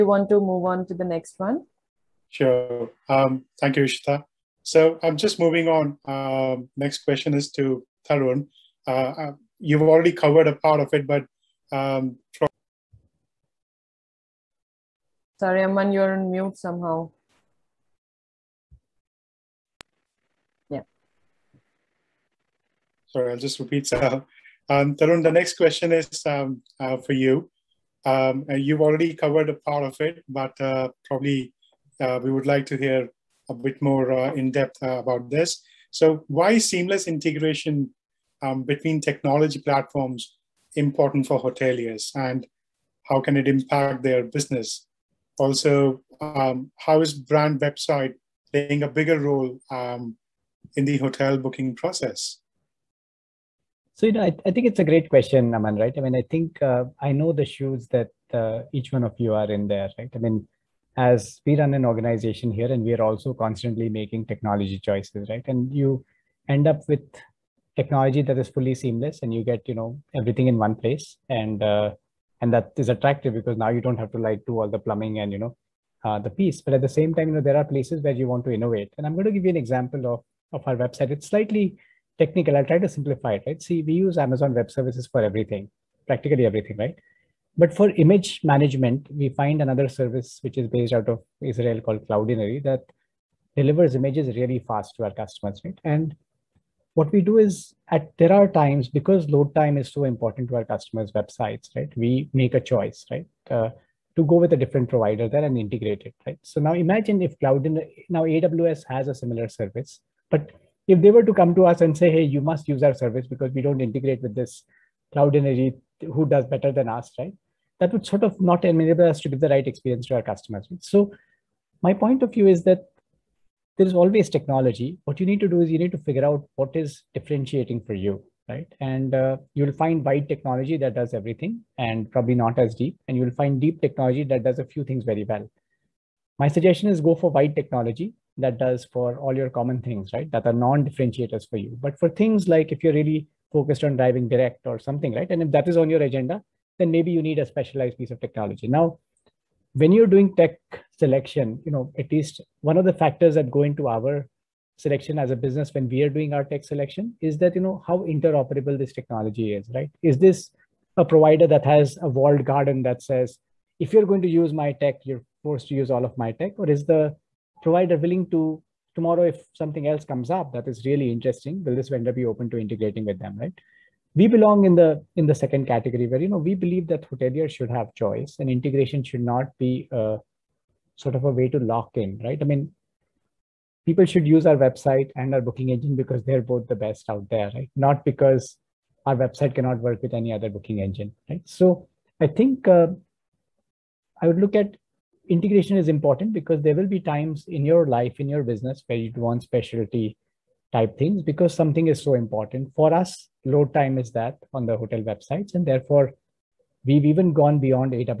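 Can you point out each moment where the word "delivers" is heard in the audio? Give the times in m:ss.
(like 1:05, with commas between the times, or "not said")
1:33.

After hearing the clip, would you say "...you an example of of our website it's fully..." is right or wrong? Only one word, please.
wrong.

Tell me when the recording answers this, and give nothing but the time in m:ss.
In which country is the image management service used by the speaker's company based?
1:31.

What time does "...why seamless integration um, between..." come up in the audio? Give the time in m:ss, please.
0:36.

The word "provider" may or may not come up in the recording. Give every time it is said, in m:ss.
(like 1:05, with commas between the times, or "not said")
1:44, 2:41, 2:47.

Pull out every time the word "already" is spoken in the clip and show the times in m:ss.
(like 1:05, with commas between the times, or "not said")
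0:09, 0:28.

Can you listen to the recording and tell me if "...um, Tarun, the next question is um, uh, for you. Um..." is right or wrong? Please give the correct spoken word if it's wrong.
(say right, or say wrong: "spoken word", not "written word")
right.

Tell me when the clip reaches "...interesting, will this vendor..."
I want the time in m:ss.
2:51.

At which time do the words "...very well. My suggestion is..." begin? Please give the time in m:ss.
2:15.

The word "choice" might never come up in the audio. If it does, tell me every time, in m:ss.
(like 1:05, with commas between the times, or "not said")
1:04, 1:42, 2:57.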